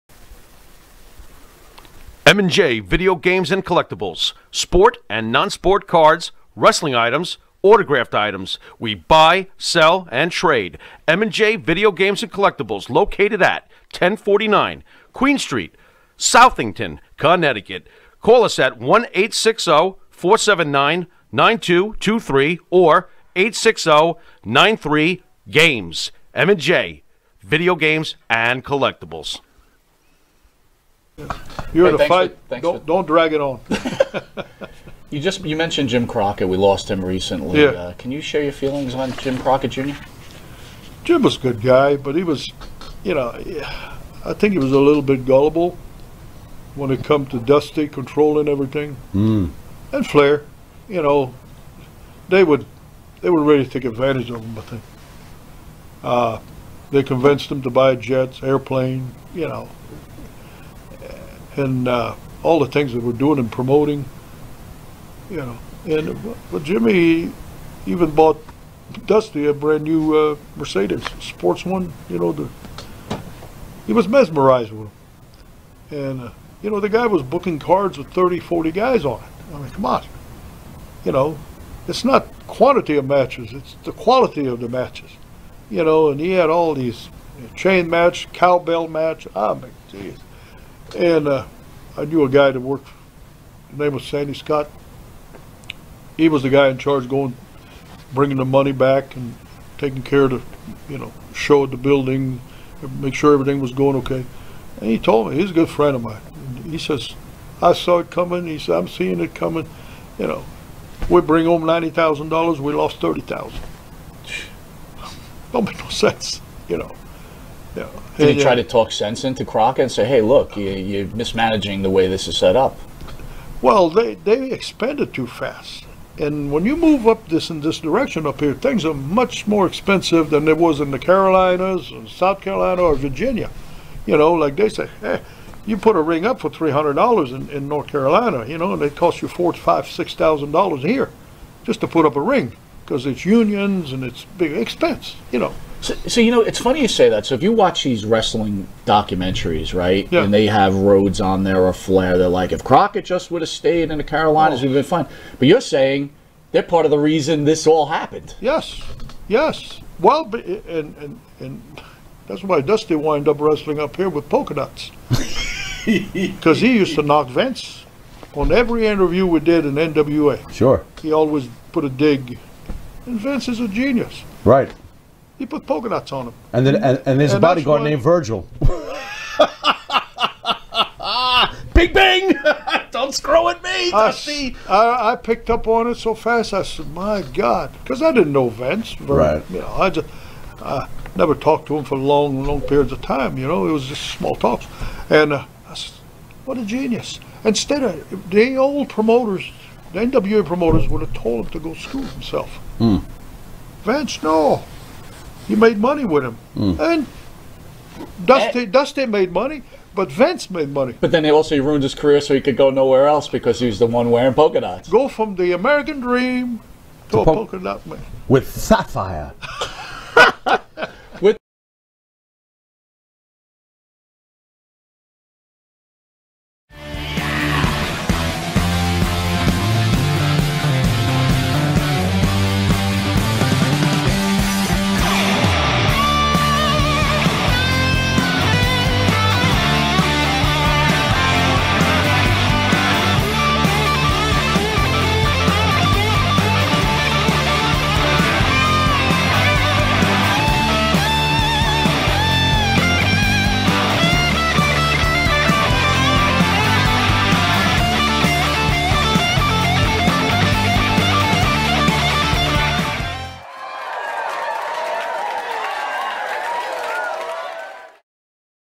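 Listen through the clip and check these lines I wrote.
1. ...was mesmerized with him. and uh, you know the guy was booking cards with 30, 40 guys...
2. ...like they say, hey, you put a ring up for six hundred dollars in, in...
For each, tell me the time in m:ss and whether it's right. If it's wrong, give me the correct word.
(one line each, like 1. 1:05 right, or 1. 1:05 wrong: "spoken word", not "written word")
1. 1:13 right
2. 2:14 wrong: "three", not "six".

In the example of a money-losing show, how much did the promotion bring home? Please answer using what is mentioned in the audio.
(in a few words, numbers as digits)
$90,000.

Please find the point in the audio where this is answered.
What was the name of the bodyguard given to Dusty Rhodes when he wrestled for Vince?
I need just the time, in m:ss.
2:58.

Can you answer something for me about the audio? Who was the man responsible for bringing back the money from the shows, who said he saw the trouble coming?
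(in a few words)
Sandy Scott.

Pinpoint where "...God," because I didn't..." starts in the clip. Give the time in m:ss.
3:07.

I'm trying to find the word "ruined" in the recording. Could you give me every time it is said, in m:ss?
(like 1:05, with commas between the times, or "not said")
3:31.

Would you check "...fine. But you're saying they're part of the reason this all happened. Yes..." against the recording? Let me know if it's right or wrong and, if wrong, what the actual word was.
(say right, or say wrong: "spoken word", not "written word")
right.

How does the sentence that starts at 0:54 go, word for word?
I think uh, they convinced him to buy jets, airplane, you know, and uh, all the things that we're doing and promoting.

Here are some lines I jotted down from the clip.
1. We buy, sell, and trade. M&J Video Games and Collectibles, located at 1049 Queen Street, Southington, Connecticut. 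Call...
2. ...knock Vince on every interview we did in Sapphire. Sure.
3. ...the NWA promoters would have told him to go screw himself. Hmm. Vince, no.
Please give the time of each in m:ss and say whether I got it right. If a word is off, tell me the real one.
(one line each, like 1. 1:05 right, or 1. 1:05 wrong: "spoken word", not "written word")
1. 0:08 right
2. 2:47 wrong: "NWA", not "Sapphire"
3. 3:19 right.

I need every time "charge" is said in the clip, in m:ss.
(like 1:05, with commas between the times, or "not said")
1:36.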